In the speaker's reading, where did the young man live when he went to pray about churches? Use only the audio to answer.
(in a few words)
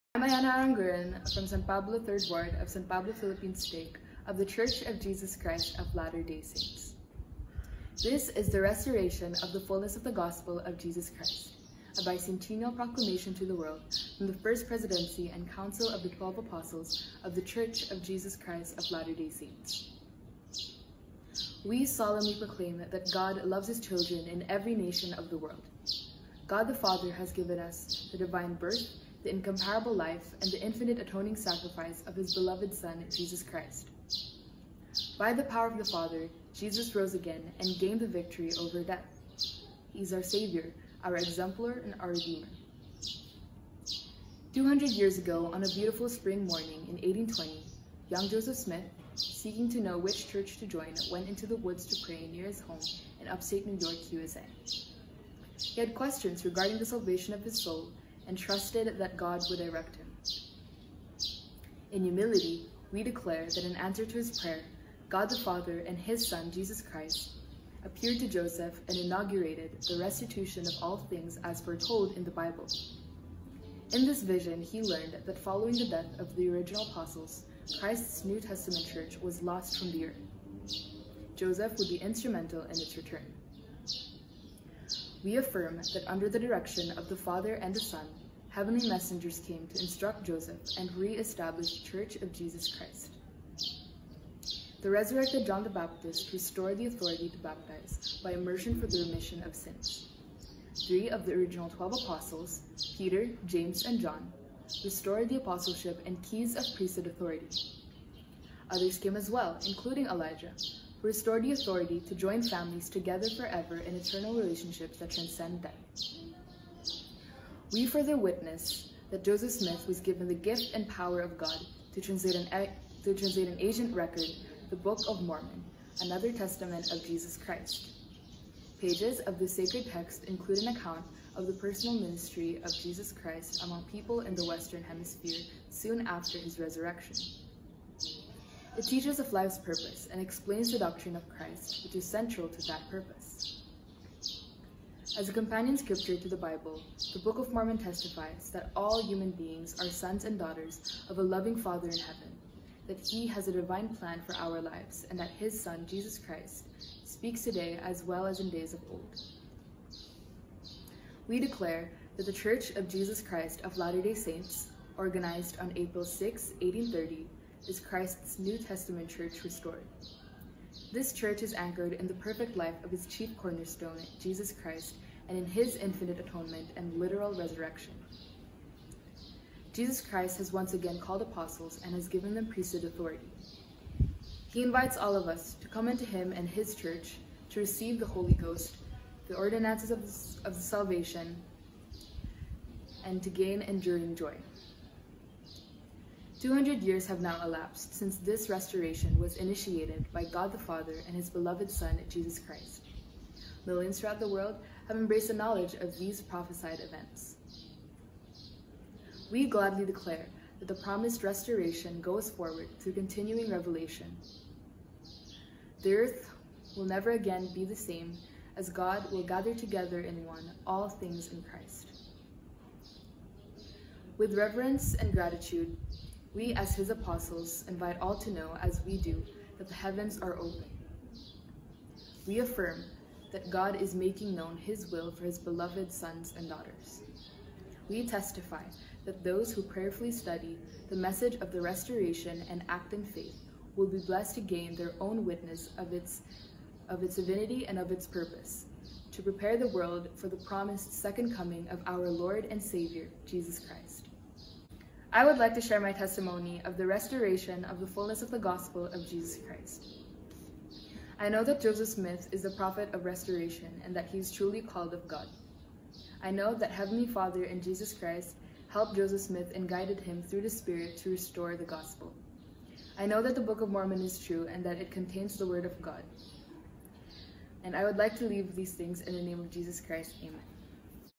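Upstate New York.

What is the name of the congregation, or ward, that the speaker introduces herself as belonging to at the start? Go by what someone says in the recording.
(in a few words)
San Pablo Third Ward.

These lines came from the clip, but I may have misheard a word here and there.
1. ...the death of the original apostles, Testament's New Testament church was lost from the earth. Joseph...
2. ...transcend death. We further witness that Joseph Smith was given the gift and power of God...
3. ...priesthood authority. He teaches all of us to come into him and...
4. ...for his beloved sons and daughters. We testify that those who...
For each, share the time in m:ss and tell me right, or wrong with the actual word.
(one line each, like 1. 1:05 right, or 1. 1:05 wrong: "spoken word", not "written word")
1. 1:15 wrong: "Christ", not "Testament"
2. 1:55 right
3. 3:02 wrong: "invites", not "teaches"
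4. 3:55 right.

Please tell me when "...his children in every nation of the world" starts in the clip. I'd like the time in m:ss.
0:23.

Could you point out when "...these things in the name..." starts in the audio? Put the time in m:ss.
4:38.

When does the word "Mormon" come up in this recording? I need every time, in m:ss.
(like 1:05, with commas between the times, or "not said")
2:05, 2:27, 4:33.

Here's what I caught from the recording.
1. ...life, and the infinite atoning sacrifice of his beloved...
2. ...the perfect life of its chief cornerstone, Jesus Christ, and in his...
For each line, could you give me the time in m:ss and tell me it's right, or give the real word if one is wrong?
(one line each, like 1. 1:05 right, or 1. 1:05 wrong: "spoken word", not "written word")
1. 0:29 right
2. 2:52 right.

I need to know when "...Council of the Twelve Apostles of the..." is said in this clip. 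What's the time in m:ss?
0:15.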